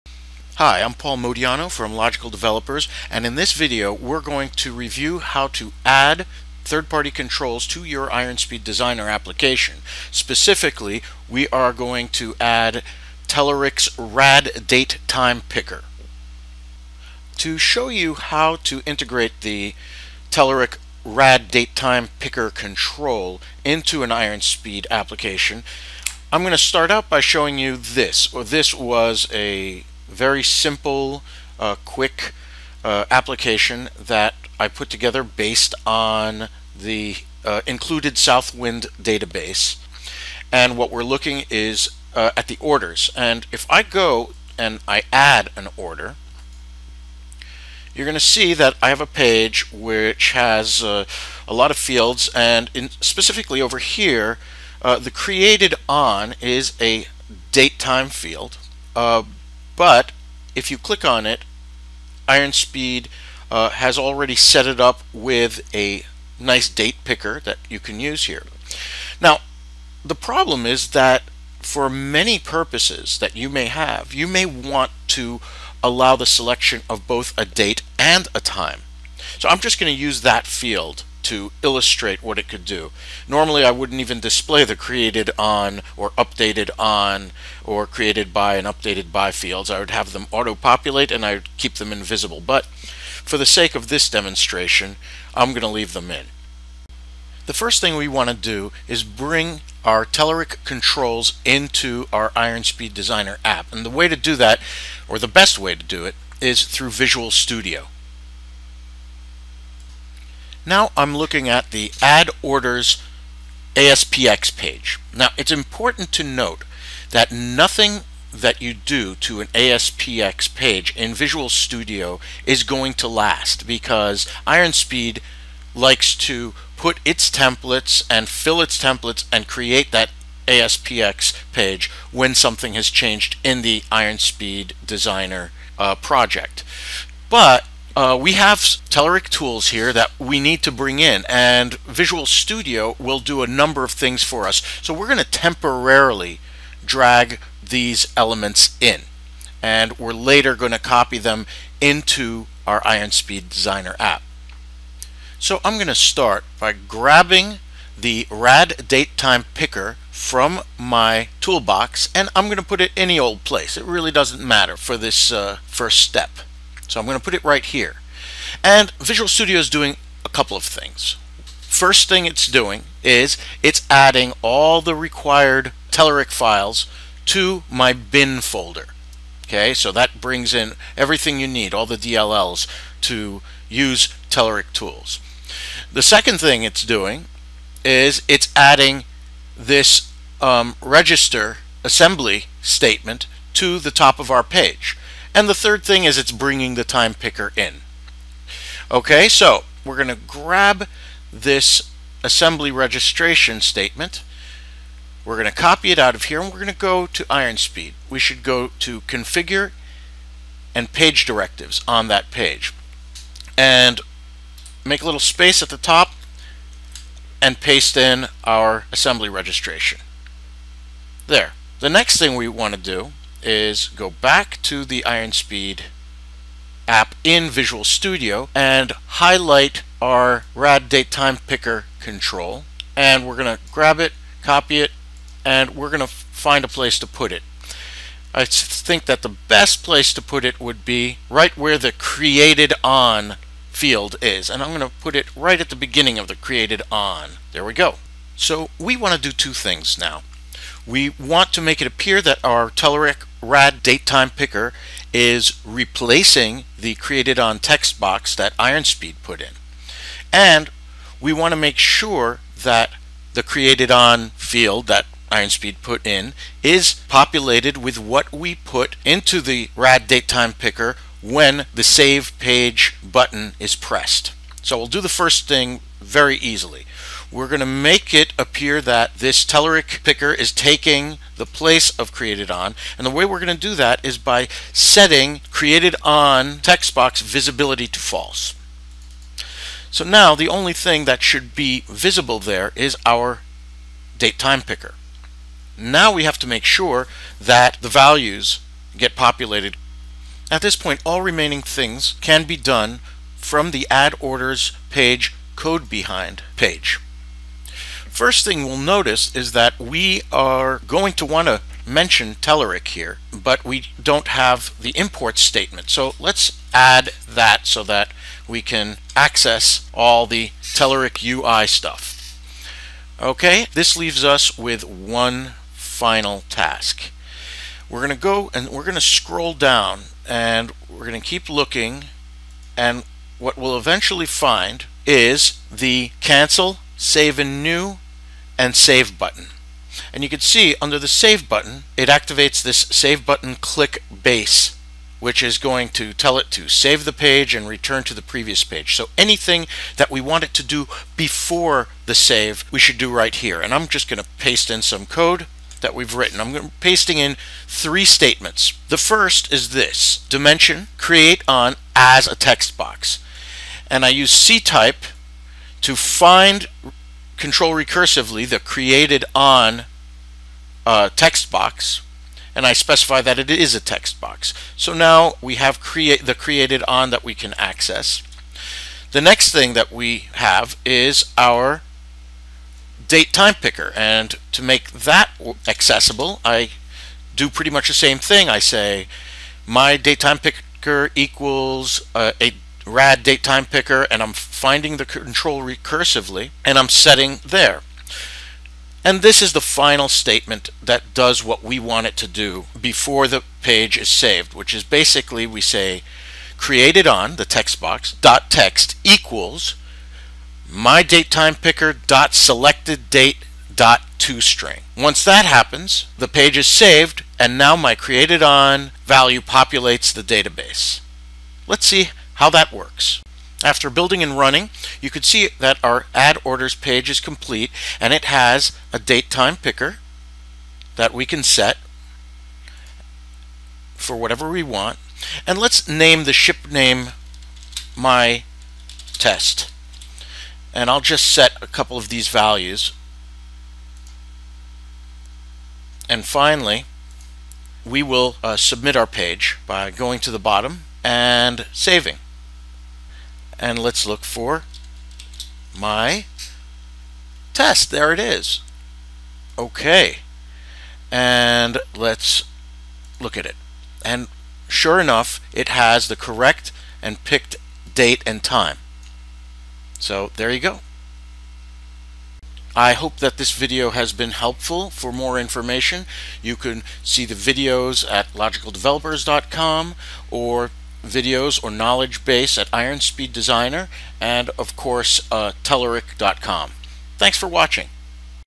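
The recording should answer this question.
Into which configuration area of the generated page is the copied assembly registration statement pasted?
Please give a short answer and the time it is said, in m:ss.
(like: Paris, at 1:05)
page directives, at 3:30.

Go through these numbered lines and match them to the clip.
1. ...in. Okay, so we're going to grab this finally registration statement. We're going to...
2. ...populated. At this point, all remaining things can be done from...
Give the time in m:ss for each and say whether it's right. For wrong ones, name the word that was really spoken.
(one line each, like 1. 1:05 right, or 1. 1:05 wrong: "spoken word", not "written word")
1. 3:17 wrong: "assembly", not "finally"
2. 4:59 right.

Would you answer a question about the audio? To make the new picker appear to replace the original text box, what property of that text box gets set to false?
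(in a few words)
visibility.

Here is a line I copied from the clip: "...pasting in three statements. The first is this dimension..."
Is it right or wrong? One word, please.
right.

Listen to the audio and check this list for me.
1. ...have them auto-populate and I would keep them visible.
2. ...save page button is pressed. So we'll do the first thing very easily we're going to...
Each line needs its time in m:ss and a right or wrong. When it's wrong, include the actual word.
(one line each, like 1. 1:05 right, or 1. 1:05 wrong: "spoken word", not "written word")
1. 1:29 wrong: "invisible", not "visible"
2. 4:31 right.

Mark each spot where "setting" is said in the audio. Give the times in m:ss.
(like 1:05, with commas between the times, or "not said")
4:44, 6:36.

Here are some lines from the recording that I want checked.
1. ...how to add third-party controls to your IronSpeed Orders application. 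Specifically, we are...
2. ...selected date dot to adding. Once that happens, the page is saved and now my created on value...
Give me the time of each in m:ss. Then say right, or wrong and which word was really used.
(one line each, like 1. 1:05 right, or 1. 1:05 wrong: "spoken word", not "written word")
1. 0:05 wrong: "Designer", not "Orders"
2. 6:52 wrong: "string", not "adding".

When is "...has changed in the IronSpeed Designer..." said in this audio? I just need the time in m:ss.
2:12.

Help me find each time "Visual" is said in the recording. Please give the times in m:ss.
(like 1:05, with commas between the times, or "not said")
1:46, 2:01, 2:21, 2:48, 3:47.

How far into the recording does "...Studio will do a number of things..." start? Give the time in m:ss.
2:22.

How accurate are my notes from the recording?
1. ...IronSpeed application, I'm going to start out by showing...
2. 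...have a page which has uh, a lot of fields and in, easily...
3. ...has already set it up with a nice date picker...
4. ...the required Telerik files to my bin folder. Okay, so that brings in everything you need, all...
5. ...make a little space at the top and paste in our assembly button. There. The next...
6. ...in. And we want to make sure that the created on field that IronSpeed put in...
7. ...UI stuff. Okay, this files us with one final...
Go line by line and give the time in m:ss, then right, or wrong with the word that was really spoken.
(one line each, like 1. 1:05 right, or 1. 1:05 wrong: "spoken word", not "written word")
1. 0:24 right
2. 0:48 wrong: "specifically", not "easily"
3. 1:03 right
4. 2:54 right
5. 3:34 wrong: "registration", not "button"
6. 4:19 right
7. 5:21 wrong: "leaves", not "files".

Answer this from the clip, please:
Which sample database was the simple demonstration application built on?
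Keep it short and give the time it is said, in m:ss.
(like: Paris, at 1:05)
Southwind, at 0:38.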